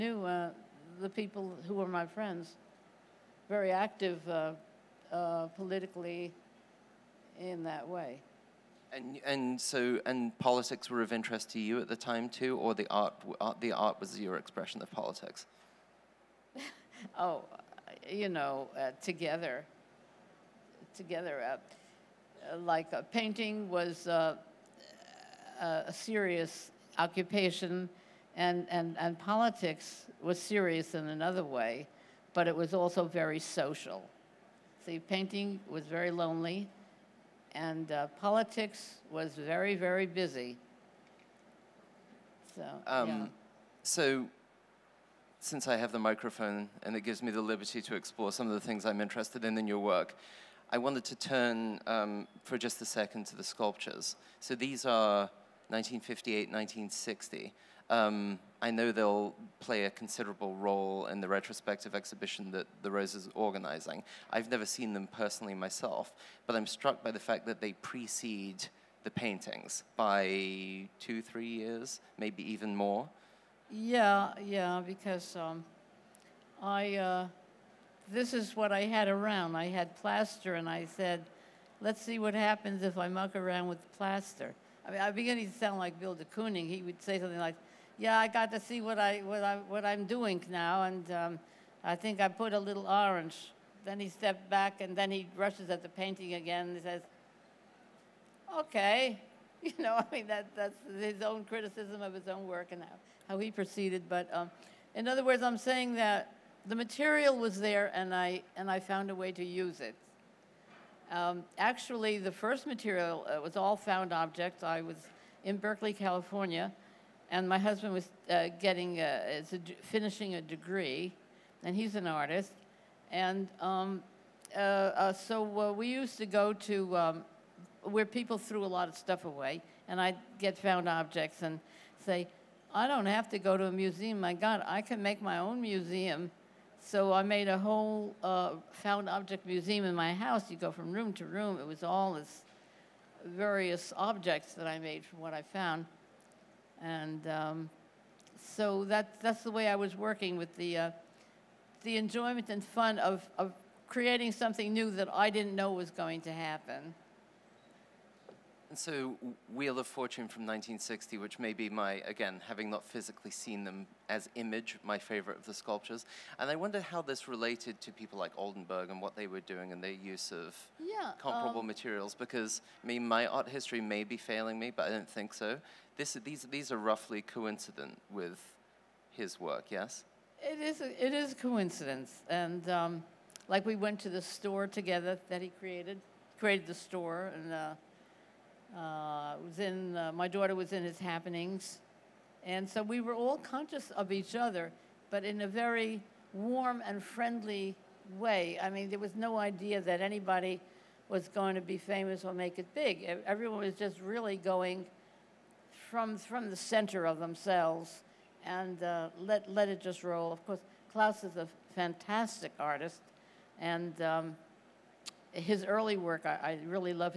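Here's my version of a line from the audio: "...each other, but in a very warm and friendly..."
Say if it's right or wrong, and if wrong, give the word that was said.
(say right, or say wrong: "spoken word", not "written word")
right.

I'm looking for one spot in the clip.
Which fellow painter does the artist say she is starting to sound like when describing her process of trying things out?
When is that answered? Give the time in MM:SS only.
01:25.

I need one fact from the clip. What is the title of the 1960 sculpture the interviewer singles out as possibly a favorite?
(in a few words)
Wheel of Fortune.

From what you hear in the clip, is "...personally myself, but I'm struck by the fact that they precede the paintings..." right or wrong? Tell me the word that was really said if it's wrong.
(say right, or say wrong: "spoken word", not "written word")
right.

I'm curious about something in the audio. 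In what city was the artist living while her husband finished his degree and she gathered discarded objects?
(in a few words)
Berkeley, California.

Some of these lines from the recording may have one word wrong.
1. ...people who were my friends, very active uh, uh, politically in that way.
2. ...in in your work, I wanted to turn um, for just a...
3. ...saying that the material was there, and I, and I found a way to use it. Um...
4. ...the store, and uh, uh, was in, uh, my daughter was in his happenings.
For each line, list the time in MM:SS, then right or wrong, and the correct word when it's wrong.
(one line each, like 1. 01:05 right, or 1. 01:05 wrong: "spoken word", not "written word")
1. 00:01 right
2. 00:49 right
3. 01:45 right
4. 03:06 right.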